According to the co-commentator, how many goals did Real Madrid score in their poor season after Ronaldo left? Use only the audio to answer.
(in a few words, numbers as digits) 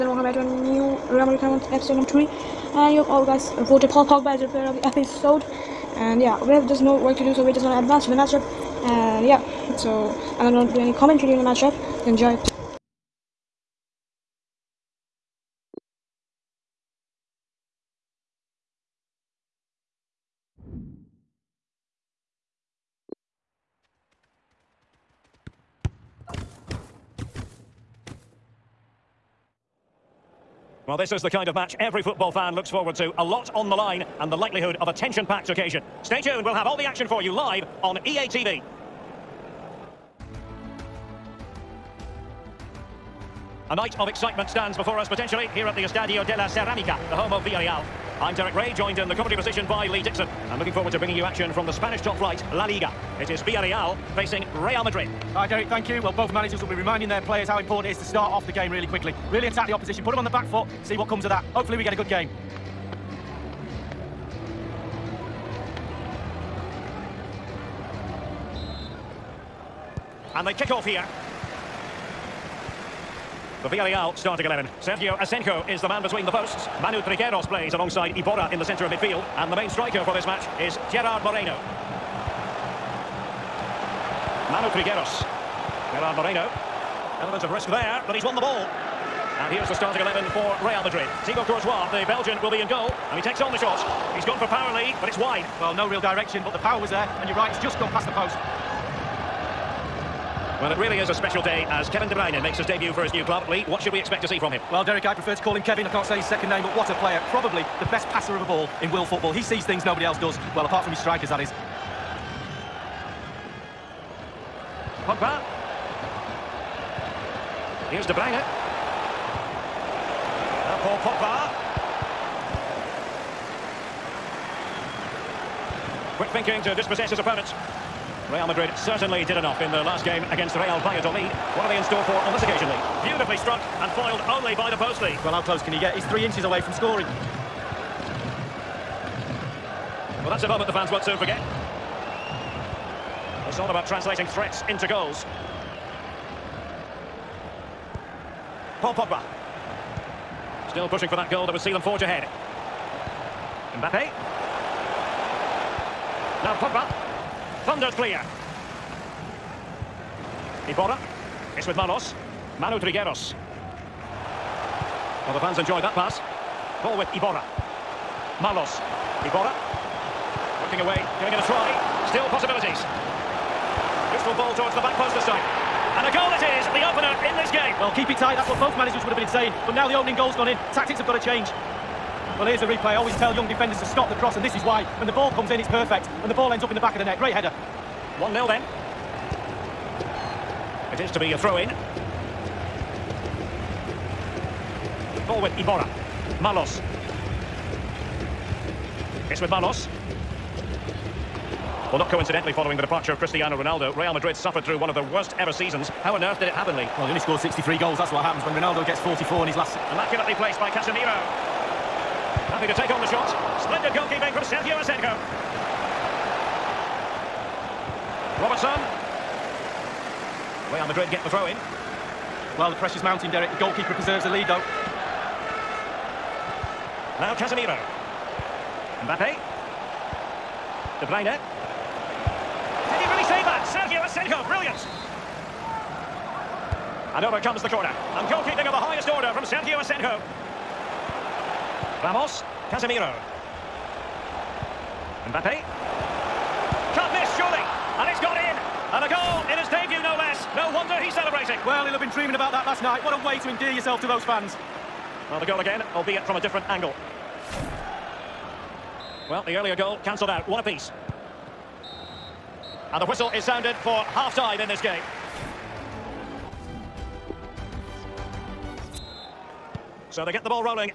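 63.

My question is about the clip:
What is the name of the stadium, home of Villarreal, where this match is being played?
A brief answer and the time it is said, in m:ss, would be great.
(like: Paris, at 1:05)
Estadio de la Ceramica, at 0:45.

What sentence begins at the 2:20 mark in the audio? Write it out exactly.
Well, that's a moment the fans won't soon forget.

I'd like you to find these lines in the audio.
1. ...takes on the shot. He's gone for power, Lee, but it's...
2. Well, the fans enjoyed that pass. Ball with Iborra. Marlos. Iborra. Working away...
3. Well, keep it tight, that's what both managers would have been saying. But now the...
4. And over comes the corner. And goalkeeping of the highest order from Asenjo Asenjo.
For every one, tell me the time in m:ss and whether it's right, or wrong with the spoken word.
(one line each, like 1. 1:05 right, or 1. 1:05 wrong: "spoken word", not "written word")
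1. 1:33 right
2. 2:45 right
3. 2:57 right
4. 3:57 wrong: "Sergio", not "Asenjo".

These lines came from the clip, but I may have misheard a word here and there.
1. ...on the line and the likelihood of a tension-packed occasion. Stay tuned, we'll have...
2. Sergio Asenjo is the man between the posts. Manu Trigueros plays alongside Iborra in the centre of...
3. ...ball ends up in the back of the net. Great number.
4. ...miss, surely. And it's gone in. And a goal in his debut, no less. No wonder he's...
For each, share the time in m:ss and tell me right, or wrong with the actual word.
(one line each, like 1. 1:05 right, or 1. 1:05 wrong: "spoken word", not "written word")
1. 0:33 right
2. 1:14 right
3. 3:06 wrong: "header", not "number"
4. 4:07 right.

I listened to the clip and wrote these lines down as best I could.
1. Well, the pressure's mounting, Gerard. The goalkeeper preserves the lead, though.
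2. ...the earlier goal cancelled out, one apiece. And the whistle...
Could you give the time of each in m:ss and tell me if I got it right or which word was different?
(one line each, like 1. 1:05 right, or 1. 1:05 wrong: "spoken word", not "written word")
1. 3:42 wrong: "Derek", not "Gerard"
2. 4:19 right.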